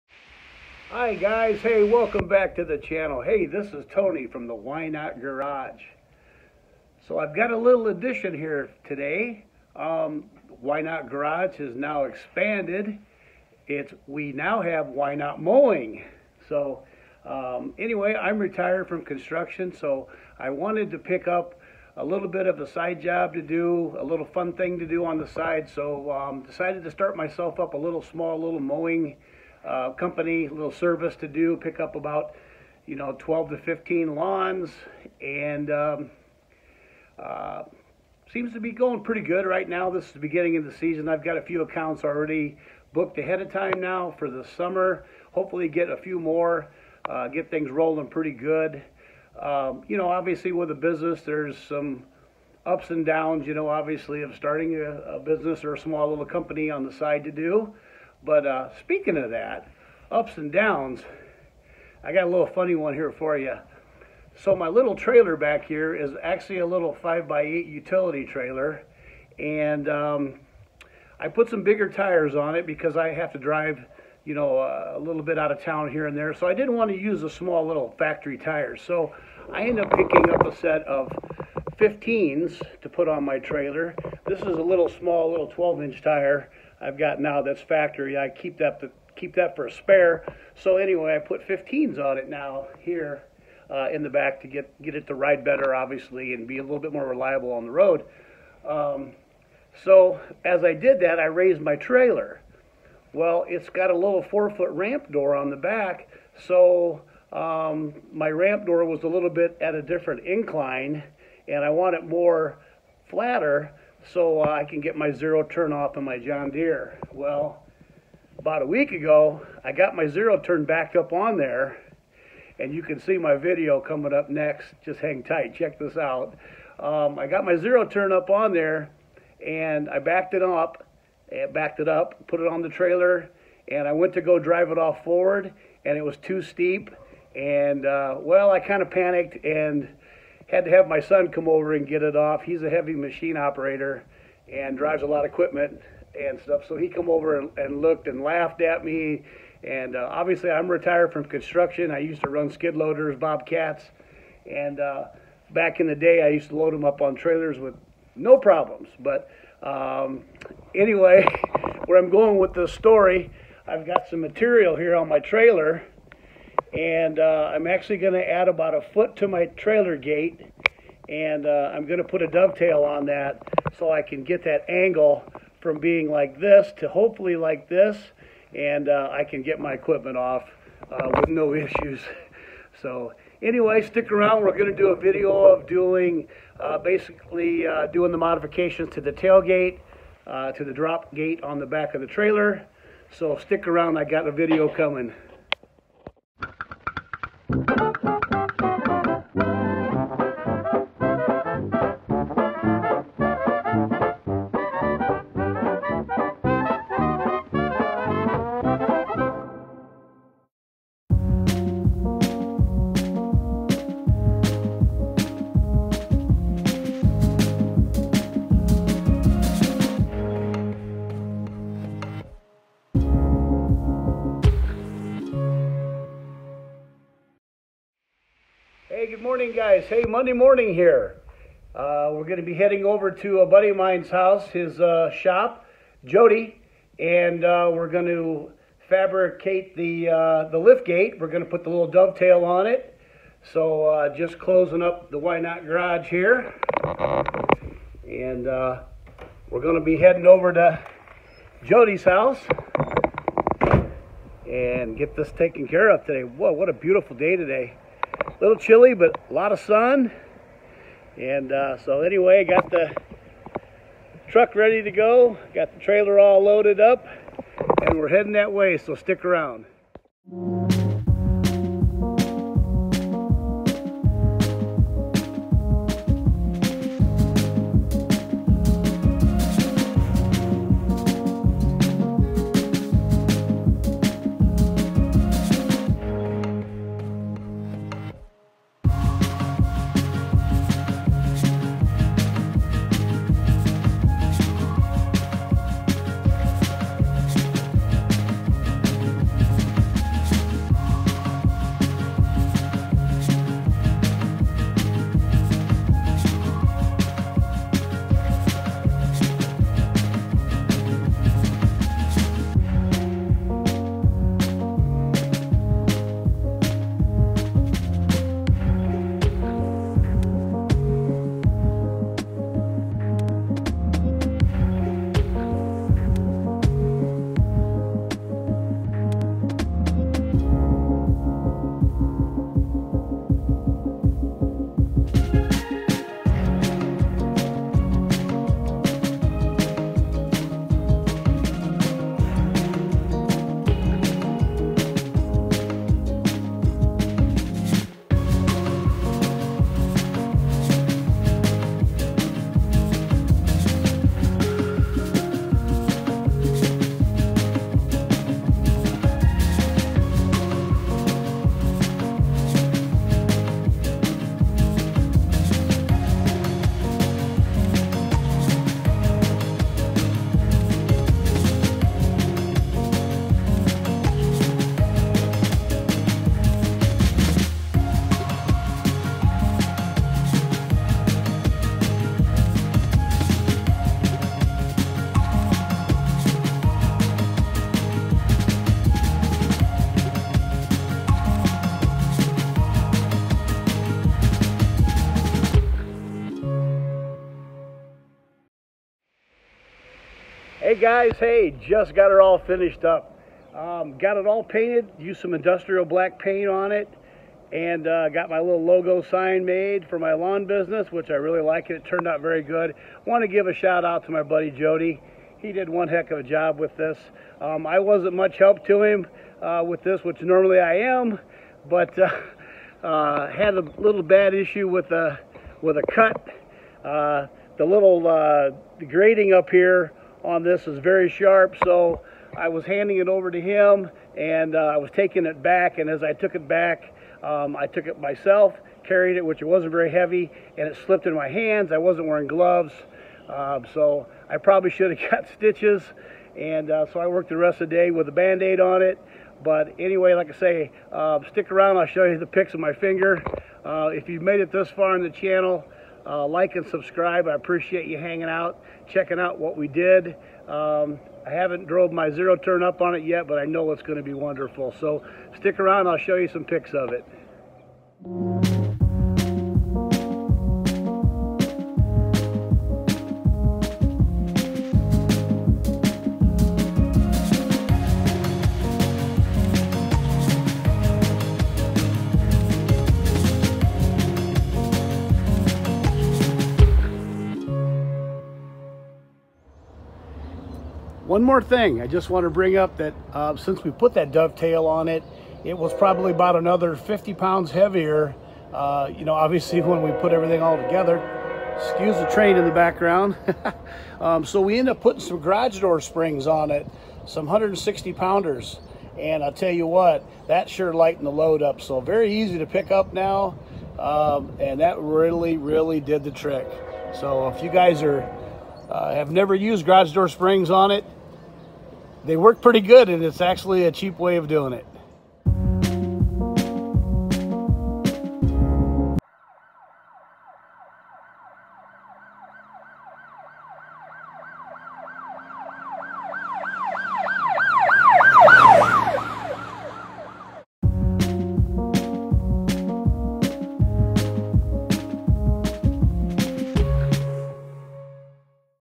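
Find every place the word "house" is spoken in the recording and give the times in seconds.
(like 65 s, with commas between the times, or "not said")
234 s, 252 s.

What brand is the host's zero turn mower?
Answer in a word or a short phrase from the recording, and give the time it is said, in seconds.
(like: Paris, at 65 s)
John Deere, at 116 s.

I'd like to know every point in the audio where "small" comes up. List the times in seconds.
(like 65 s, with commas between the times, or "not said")
28 s, 55 s, 77 s, 84 s.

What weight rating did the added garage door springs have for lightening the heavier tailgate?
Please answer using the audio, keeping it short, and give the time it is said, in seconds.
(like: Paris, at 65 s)
160 pounds, at 507 s.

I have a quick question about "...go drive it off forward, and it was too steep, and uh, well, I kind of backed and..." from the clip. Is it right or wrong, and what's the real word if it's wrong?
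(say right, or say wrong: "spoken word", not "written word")
wrong: "panicked", not "backed".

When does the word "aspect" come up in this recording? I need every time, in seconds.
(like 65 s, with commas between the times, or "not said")
not said.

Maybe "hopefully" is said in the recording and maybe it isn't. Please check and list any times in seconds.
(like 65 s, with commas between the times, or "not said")
45 s, 176 s.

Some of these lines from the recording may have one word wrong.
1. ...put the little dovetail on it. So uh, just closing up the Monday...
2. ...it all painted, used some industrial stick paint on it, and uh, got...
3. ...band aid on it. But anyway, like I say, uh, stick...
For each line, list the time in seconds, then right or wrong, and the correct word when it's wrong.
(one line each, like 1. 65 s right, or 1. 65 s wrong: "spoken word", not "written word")
1. 241 s wrong: "Ynot", not "Monday"
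2. 404 s wrong: "black", not "stick"
3. 448 s right.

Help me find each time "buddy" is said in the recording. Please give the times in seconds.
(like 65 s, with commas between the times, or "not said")
233 s, 414 s.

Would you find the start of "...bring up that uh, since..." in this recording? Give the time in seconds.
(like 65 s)
492 s.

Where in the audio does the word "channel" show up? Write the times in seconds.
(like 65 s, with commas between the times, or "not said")
2 s, 455 s.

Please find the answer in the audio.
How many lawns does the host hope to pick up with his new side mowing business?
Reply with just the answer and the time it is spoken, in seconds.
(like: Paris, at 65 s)
12 to 15, at 33 s.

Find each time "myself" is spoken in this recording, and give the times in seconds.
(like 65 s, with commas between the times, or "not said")
27 s, 437 s.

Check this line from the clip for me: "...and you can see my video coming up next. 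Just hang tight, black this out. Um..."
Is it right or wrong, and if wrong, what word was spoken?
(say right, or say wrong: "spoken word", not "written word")
wrong: "check", not "black".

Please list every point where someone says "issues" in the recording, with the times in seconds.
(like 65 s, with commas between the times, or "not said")
181 s, 424 s.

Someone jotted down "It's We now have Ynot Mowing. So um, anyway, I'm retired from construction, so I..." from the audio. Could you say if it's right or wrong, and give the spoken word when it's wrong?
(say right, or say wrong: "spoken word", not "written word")
right.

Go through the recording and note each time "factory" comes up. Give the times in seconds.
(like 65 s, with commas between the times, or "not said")
77 s, 87 s.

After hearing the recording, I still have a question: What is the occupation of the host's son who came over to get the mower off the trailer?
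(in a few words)
Heavy machine operator.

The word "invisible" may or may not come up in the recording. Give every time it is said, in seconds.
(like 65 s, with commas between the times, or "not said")
not said.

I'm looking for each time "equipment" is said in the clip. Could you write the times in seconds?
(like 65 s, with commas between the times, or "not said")
145 s, 179 s.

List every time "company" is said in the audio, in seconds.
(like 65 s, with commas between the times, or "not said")
29 s, 56 s.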